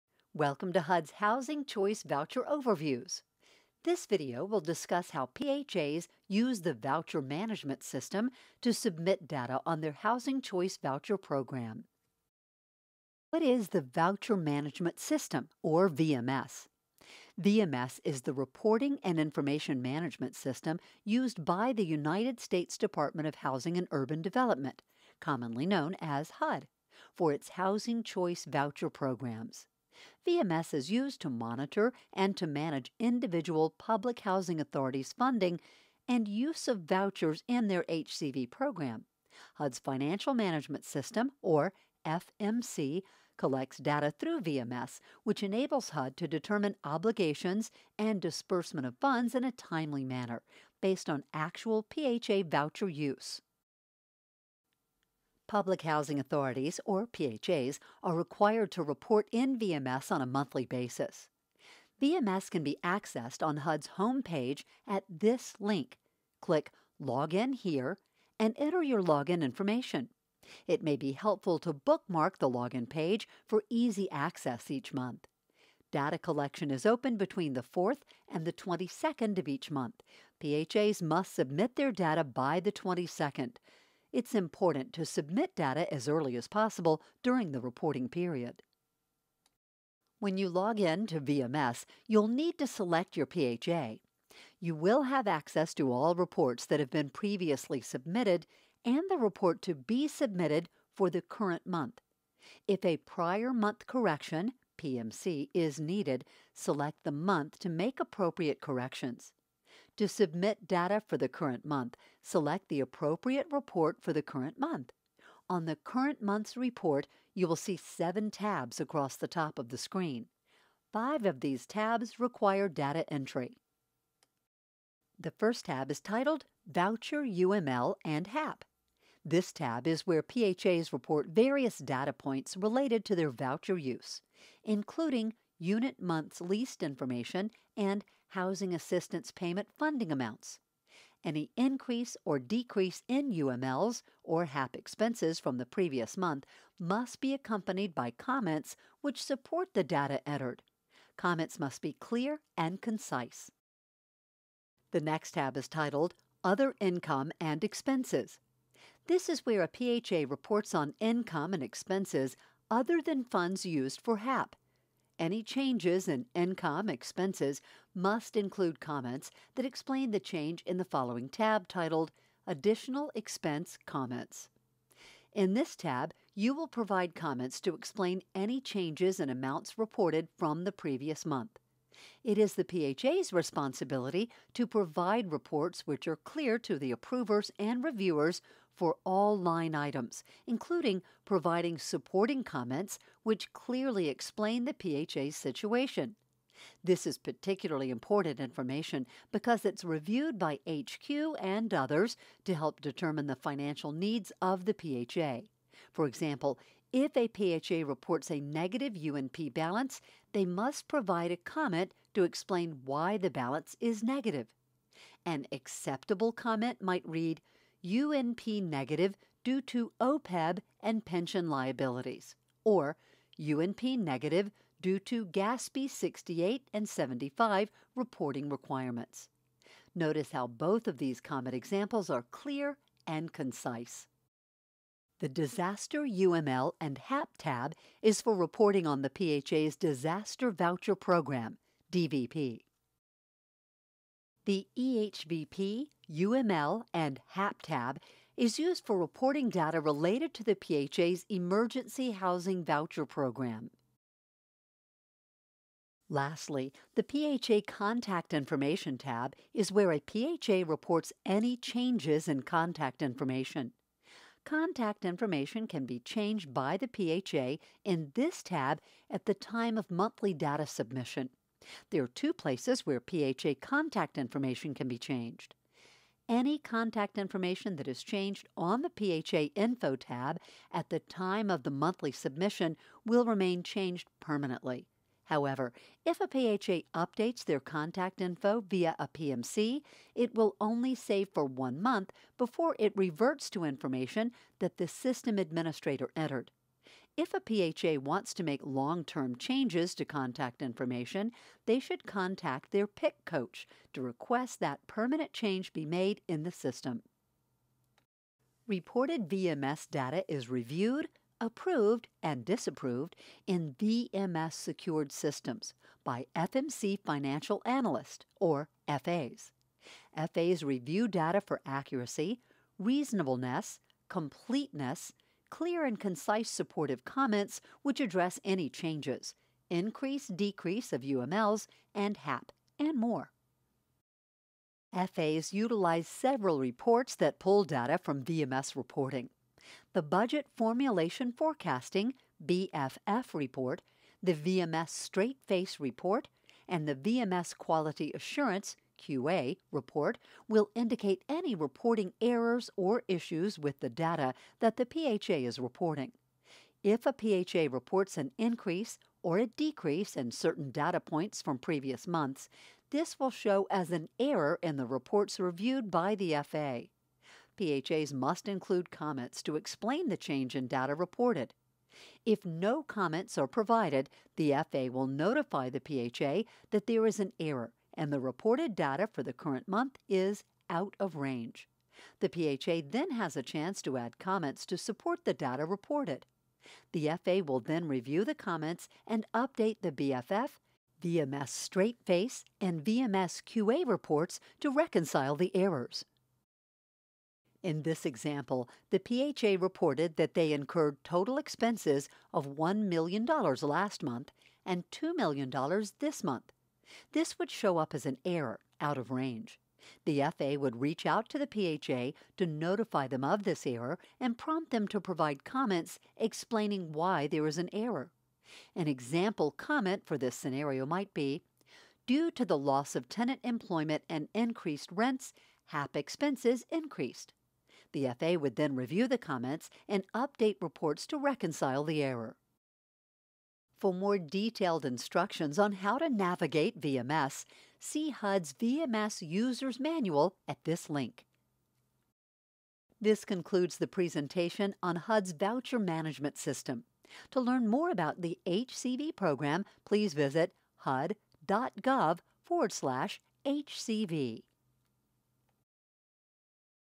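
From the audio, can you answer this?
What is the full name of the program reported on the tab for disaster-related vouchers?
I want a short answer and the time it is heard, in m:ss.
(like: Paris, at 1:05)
Disaster Voucher Program, at 3:59.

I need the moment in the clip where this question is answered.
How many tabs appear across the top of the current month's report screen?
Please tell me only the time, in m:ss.
1:57.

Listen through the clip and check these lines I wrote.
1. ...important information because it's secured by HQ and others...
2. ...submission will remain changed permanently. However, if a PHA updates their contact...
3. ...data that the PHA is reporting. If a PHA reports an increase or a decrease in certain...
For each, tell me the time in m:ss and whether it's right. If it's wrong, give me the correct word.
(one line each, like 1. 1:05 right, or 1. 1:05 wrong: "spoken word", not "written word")
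1. 3:17 wrong: "reviewed", not "secured"
2. 4:42 right
3. 5:53 right.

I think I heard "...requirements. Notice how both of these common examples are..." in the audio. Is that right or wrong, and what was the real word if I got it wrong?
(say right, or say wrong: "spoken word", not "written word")
right.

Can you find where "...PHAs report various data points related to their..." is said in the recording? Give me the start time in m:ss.
2:10.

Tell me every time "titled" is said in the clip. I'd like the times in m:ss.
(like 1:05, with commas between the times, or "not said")
2:06, 2:35, 2:51.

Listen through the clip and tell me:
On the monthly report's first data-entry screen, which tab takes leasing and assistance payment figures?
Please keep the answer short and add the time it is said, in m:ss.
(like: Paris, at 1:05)
Voucher UML and HAP, at 2:06.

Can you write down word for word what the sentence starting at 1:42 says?
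If a prior month correction, PMC, is needed, select the month to make appropriate corrections.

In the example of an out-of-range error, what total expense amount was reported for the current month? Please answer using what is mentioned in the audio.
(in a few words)
$2 million.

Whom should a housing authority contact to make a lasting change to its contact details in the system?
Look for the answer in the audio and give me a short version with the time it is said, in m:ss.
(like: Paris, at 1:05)
PIC coach, at 5:02.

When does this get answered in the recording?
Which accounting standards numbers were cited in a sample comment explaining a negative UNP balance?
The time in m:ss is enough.
3:45.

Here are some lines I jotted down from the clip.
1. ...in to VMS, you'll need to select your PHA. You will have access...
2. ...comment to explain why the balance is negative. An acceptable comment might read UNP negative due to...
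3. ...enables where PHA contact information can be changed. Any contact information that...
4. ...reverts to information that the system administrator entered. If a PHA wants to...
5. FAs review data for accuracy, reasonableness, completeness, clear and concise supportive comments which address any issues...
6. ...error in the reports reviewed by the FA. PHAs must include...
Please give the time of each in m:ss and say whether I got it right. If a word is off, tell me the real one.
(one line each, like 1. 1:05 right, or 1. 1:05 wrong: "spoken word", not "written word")
1. 1:30 right
2. 3:31 right
3. 4:32 wrong: "places", not "enables"
4. 4:52 right
5. 5:20 wrong: "changes", not "issues"
6. 6:04 right.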